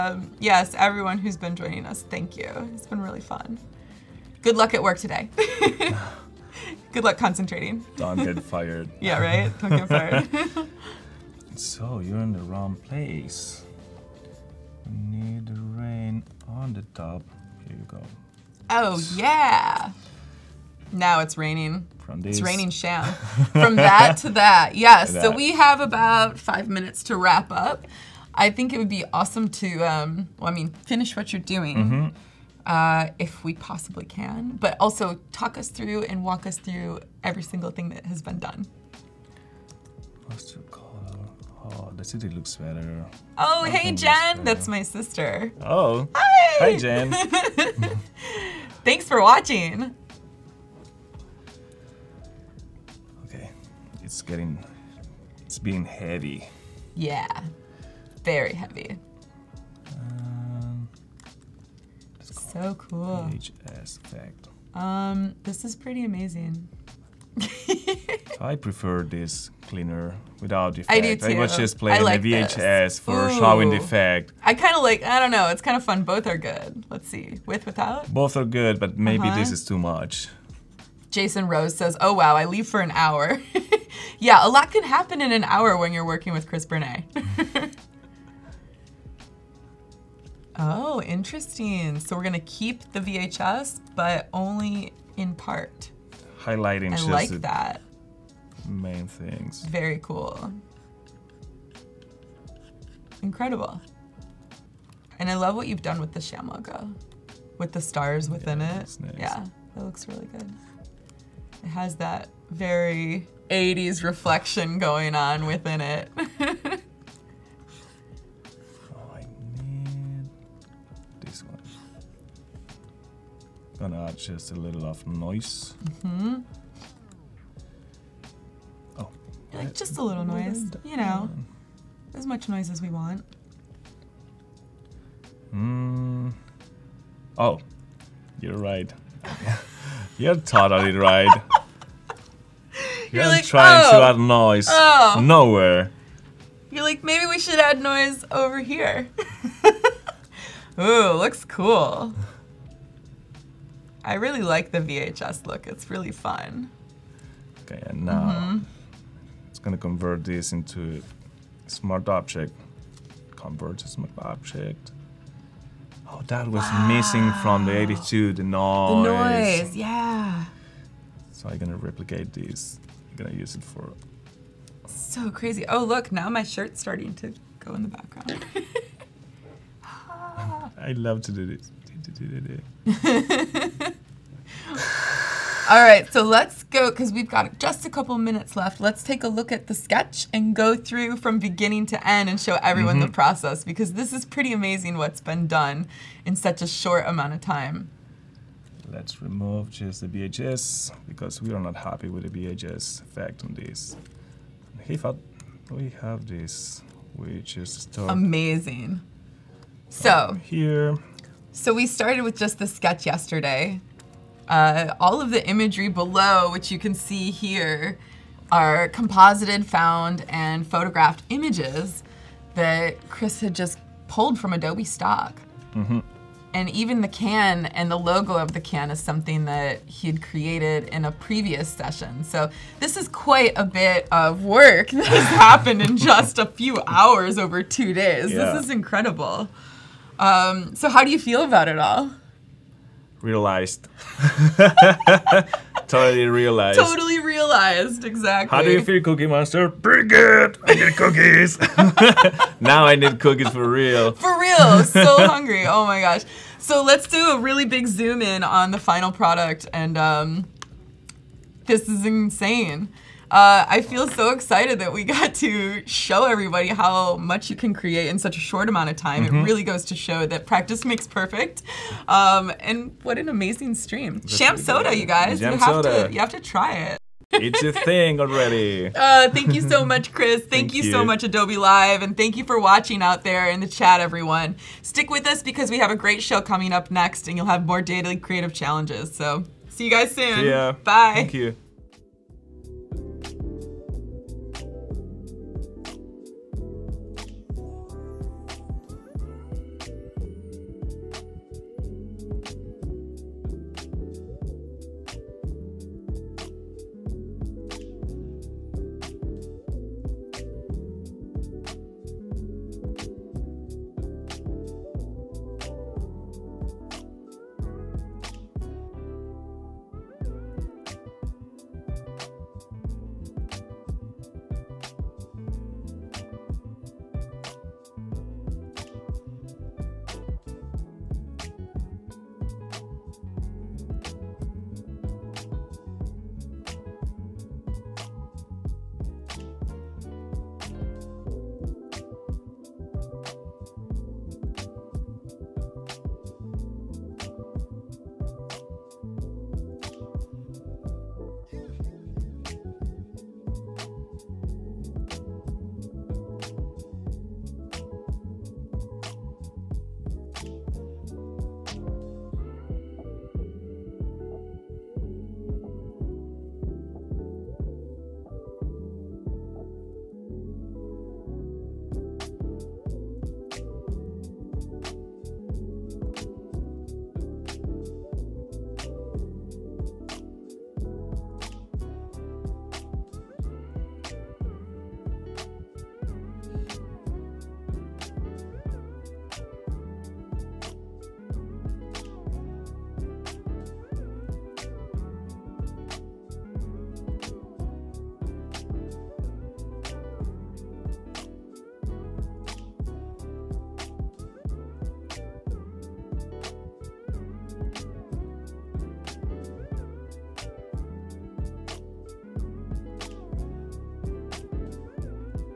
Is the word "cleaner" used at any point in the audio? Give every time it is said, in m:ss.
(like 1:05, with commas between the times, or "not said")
1:09.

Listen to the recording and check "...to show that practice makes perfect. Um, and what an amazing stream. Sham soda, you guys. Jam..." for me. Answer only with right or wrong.
right.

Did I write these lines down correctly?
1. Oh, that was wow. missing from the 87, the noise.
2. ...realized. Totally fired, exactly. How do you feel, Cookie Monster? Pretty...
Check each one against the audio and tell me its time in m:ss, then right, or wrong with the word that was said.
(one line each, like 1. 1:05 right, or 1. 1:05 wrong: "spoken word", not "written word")
1. 2:46 wrong: "82", not "87"
2. 4:06 wrong: "realized", not "fired".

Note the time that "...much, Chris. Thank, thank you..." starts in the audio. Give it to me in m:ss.
4:39.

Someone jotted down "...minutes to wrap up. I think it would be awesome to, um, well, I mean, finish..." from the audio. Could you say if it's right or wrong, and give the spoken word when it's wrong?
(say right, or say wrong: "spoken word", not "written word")
right.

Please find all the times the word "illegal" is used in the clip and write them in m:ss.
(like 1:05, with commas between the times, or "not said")
not said.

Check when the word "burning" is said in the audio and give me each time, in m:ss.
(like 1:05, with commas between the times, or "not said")
not said.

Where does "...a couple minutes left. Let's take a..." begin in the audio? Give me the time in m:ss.
3:07.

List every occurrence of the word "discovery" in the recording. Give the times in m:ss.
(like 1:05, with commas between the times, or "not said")
not said.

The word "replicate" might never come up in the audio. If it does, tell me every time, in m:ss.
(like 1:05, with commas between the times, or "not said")
2:51.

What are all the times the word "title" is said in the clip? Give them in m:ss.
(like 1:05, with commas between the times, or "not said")
not said.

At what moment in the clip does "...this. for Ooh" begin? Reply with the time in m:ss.
1:12.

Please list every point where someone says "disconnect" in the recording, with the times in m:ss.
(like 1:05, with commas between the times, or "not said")
not said.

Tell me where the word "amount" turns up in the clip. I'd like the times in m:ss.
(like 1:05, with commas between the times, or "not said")
3:17, 4:28.